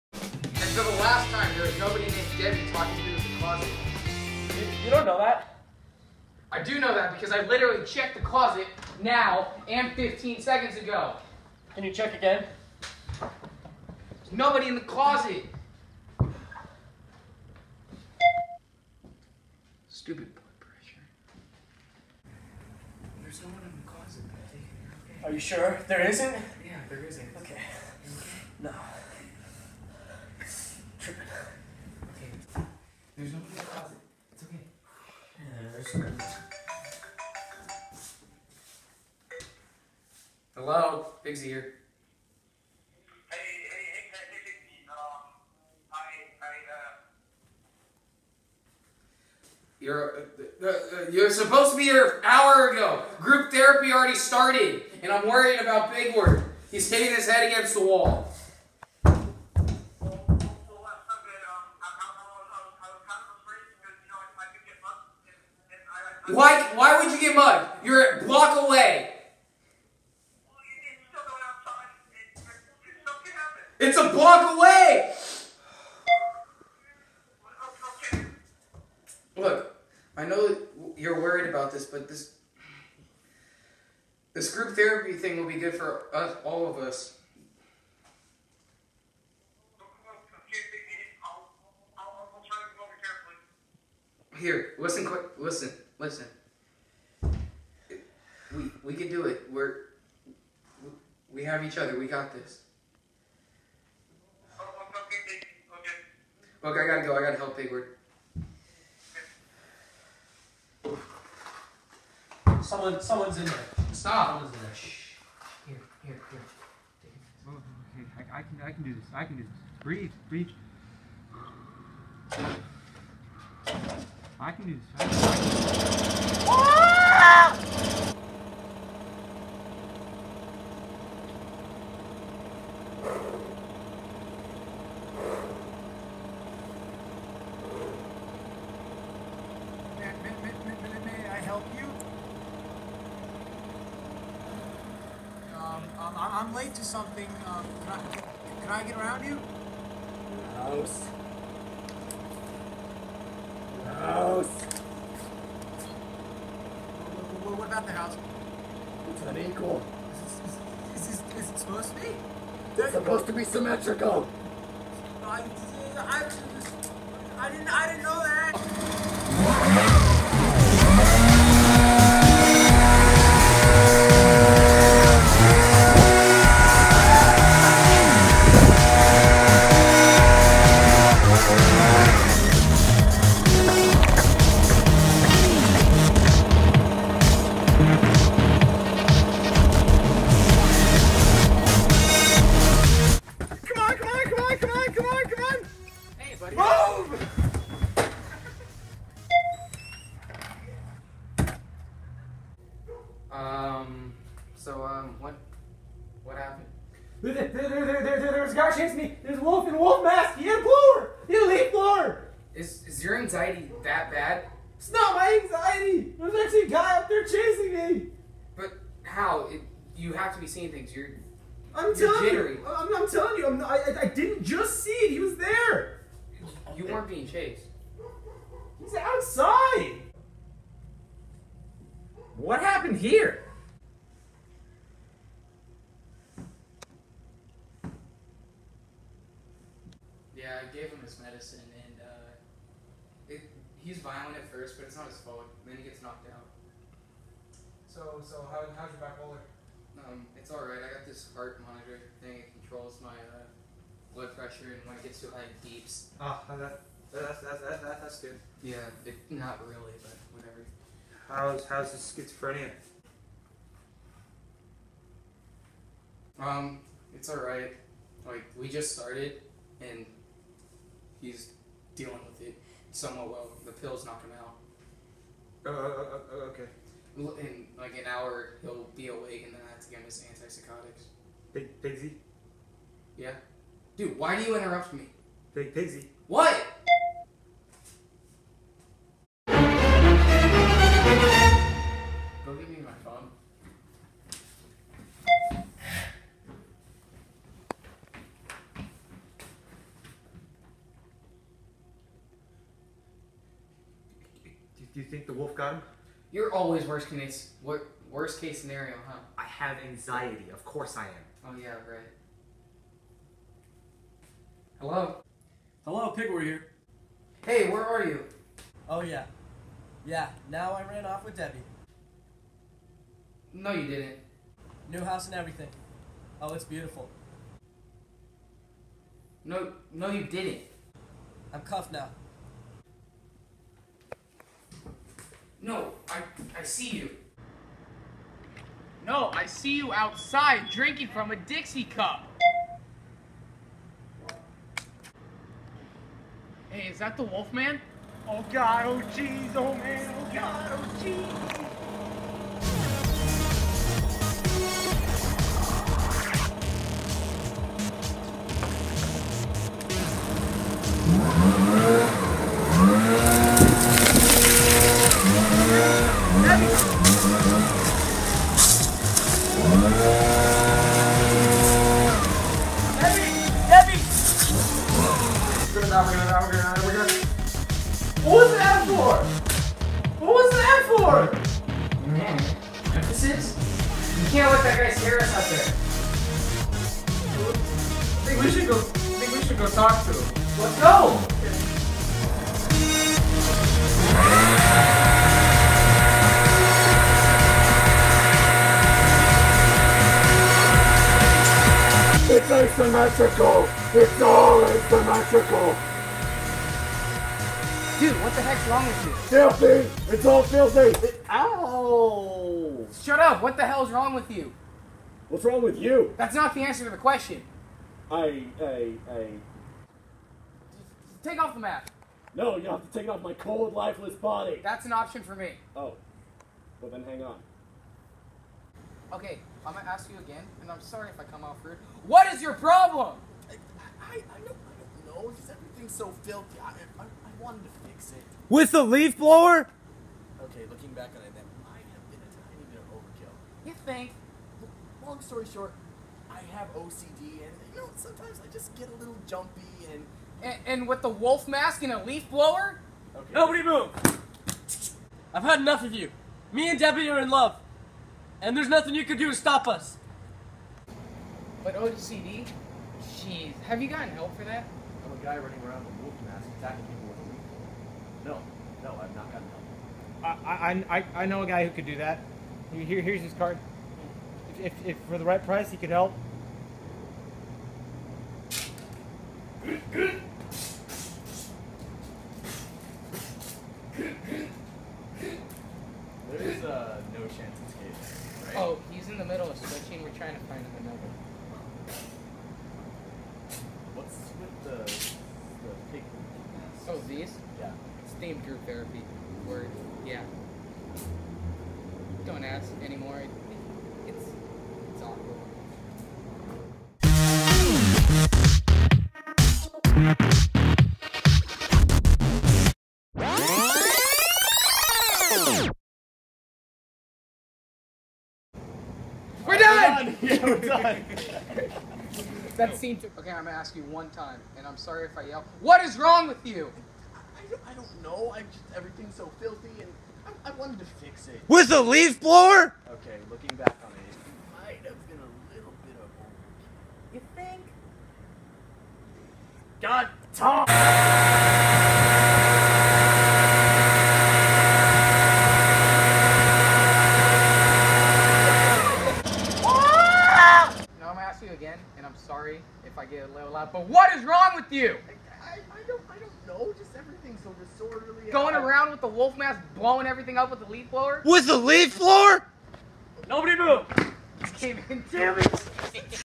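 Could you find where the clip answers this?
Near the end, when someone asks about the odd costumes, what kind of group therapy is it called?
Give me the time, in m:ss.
8:18.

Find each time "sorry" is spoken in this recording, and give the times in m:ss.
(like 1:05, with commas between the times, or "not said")
7:10, 8:44, 9:12.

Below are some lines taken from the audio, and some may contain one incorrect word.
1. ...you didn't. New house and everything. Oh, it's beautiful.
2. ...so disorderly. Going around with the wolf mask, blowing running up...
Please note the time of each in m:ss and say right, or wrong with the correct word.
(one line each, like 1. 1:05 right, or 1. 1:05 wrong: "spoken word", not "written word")
1. 5:23 right
2. 9:17 wrong: "everything", not "running".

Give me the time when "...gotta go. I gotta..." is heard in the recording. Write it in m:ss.
1:46.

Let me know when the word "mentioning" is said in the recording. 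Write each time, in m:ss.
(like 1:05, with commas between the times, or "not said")
not said.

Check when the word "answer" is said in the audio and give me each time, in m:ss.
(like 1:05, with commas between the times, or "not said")
6:56.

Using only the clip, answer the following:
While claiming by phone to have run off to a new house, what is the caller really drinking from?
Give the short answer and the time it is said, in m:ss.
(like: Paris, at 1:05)
a Dixie cup, at 5:41.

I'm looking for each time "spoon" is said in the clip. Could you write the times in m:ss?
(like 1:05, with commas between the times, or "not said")
not said.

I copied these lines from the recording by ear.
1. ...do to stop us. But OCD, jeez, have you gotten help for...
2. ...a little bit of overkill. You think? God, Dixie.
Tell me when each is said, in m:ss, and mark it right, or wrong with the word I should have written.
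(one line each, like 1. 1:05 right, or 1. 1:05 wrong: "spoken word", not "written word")
1. 7:39 right
2. 8:55 wrong: "Tom", not "Dixie".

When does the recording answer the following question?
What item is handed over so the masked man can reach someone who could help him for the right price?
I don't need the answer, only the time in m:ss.
7:53.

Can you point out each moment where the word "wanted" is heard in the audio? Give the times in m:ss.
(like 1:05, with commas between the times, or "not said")
7:17, 8:50.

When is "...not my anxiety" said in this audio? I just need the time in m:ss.
3:34.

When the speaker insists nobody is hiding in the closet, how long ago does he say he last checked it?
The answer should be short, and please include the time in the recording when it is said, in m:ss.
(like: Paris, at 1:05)
15 seconds ago, at 0:09.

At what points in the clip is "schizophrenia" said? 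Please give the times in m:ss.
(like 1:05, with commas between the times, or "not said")
4:22.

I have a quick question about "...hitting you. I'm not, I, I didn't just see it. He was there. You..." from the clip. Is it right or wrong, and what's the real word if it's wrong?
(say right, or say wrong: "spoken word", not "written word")
wrong: "telling", not "hitting".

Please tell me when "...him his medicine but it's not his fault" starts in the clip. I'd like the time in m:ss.
4:00.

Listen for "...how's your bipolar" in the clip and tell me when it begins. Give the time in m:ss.
4:08.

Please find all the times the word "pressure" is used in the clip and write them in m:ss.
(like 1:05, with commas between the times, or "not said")
0:20, 4:14.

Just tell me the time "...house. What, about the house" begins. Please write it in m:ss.
2:34.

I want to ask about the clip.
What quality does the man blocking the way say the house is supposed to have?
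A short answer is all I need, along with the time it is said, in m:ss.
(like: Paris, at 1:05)
symmetrical, at 2:43.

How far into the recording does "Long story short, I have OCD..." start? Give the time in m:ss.
7:25.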